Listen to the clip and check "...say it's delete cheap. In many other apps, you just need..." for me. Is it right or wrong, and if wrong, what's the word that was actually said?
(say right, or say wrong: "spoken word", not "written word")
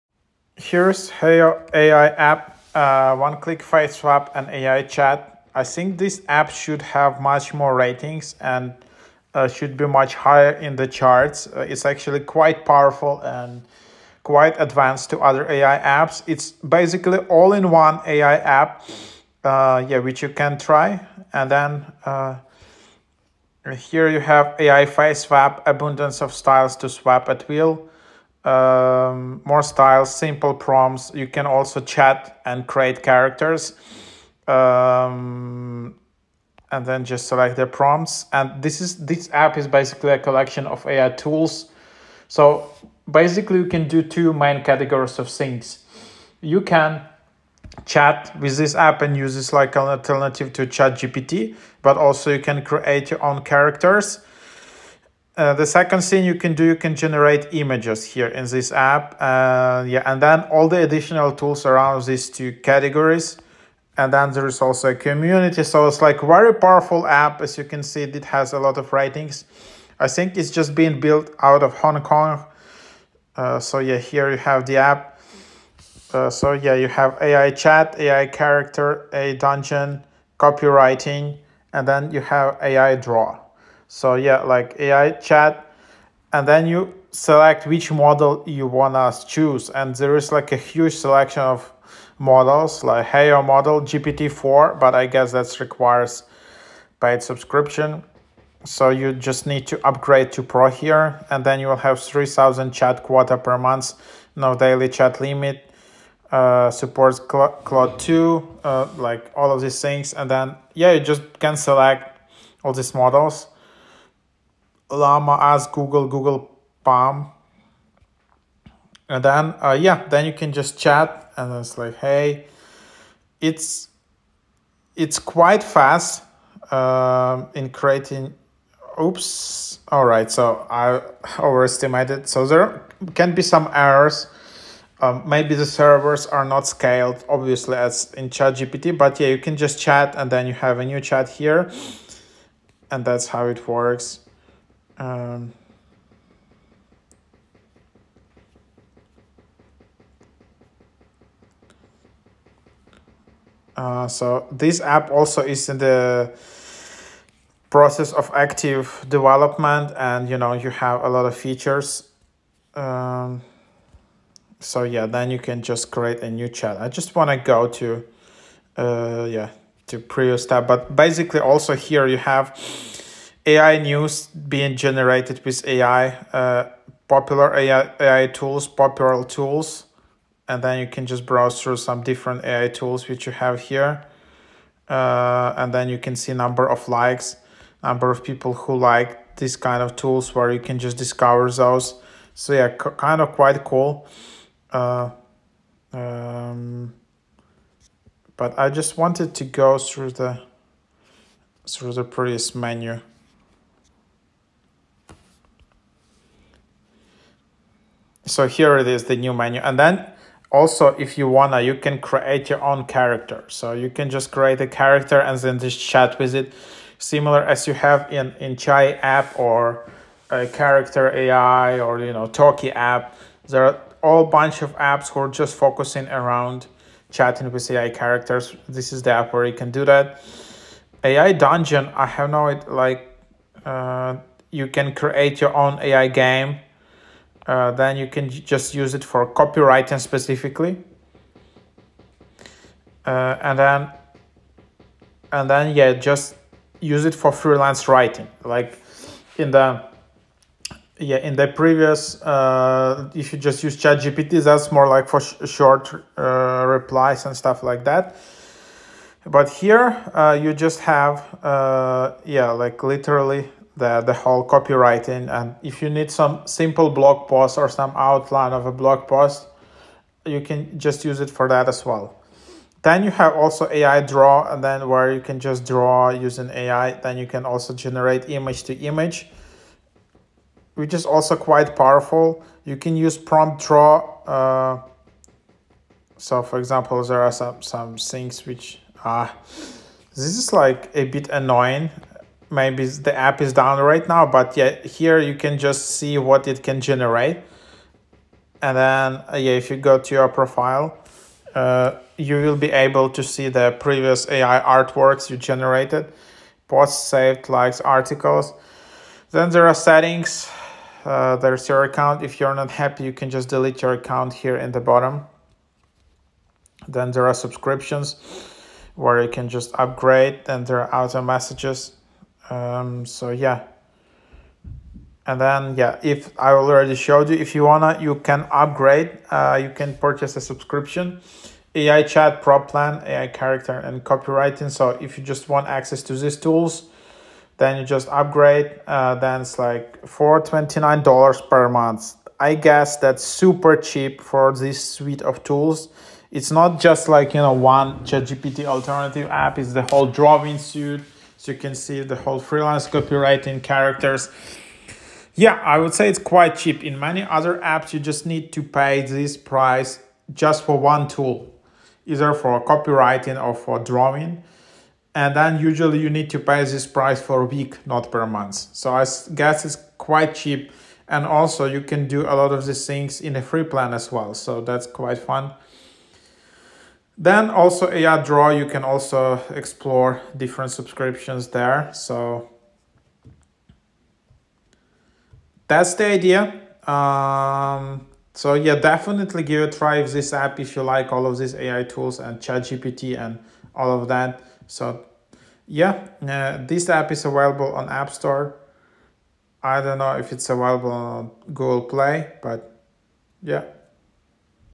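wrong: "quite", not "delete".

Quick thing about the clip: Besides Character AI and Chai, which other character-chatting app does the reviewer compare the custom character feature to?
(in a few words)
Toki.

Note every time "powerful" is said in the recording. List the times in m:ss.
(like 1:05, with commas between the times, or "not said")
0:12, 1:06, 4:41.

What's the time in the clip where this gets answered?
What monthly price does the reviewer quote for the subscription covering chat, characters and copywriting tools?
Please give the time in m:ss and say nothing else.
5:40.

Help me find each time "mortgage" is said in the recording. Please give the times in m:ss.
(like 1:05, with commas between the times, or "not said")
not said.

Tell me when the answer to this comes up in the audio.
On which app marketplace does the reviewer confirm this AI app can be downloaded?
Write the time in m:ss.
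6:37.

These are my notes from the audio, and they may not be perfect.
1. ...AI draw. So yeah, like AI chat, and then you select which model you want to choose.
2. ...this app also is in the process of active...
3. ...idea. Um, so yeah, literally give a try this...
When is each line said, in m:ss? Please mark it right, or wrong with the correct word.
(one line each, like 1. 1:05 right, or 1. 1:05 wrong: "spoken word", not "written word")
1. 1:22 right
2. 2:34 right
3. 6:26 wrong: "definitely", not "literally".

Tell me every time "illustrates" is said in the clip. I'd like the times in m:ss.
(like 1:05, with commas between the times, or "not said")
not said.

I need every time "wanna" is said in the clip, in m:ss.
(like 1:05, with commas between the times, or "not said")
3:31, 5:27.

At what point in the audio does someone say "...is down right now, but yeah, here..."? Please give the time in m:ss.
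4:53.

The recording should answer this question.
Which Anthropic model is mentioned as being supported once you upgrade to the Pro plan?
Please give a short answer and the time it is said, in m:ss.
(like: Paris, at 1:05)
Claude 2, at 1:47.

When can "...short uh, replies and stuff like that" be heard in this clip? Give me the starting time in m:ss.
4:15.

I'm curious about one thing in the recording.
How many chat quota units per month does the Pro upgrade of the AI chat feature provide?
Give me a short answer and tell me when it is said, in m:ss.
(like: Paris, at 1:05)
3,000, at 1:41.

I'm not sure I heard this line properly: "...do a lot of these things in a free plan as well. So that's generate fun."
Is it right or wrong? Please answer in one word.
wrong.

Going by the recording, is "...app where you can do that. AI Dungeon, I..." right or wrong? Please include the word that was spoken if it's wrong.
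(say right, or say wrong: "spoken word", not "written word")
right.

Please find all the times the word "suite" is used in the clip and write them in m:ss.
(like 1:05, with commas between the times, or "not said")
5:44, 5:50.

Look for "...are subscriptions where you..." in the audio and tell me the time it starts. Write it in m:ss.
5:17.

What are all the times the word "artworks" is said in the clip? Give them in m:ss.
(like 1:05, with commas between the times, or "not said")
5:04.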